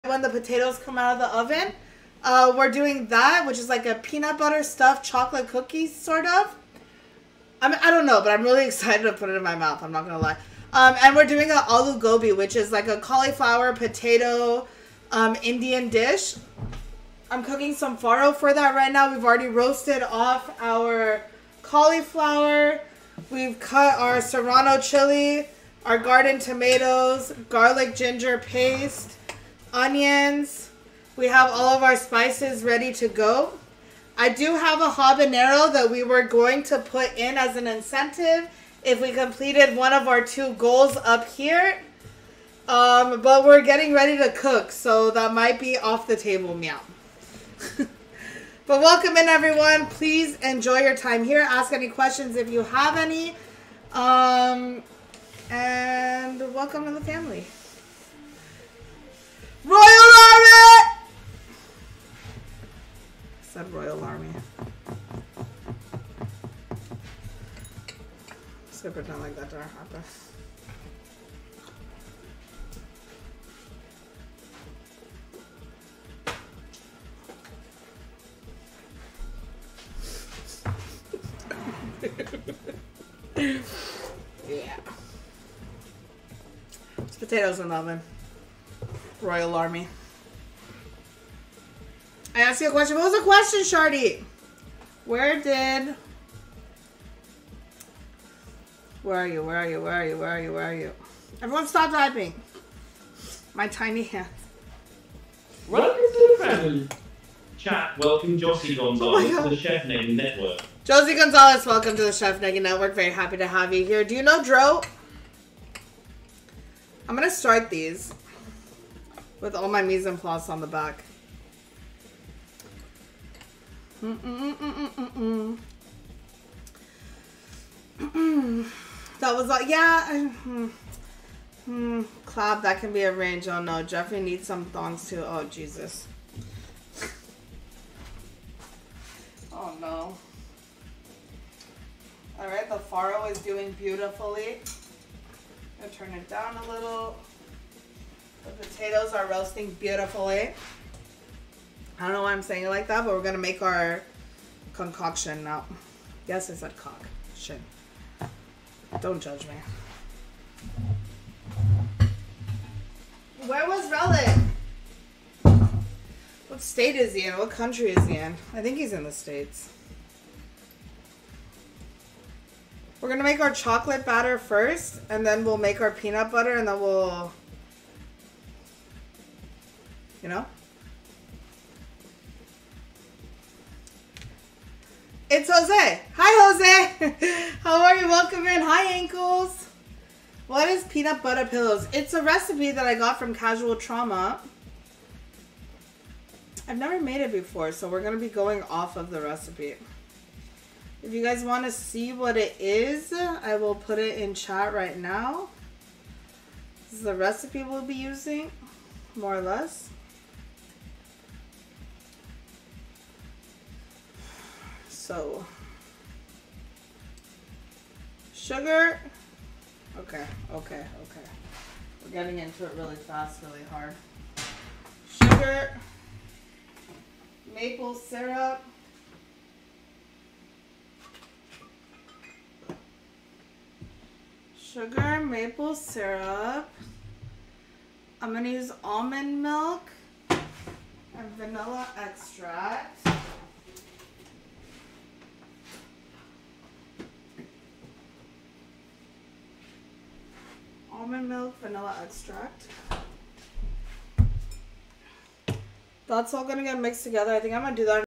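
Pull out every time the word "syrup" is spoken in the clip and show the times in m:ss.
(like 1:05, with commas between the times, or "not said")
3:47, 3:55.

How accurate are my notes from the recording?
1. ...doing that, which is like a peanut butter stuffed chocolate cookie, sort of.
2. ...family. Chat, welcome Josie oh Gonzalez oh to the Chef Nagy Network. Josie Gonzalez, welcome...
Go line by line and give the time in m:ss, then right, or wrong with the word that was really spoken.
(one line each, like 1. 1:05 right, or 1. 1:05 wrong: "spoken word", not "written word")
1. 0:02 right
2. 1:46 right.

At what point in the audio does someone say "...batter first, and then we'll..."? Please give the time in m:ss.
2:54.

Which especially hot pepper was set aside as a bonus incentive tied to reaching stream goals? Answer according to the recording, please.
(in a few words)
Habanero.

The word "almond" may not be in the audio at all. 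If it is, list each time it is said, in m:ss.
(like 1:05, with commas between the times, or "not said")
3:58, 4:11.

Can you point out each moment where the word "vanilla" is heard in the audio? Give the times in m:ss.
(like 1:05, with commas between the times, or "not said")
4:01, 4:11.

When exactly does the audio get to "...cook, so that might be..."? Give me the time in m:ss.
0:44.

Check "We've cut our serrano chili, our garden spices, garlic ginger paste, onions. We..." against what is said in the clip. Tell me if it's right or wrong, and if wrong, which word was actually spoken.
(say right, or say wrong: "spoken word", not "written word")
wrong: "tomatoes", not "spices".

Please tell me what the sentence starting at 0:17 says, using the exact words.
I'm cooking some farro for that right now.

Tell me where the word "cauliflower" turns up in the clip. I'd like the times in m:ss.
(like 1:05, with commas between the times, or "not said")
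0:12, 0:21.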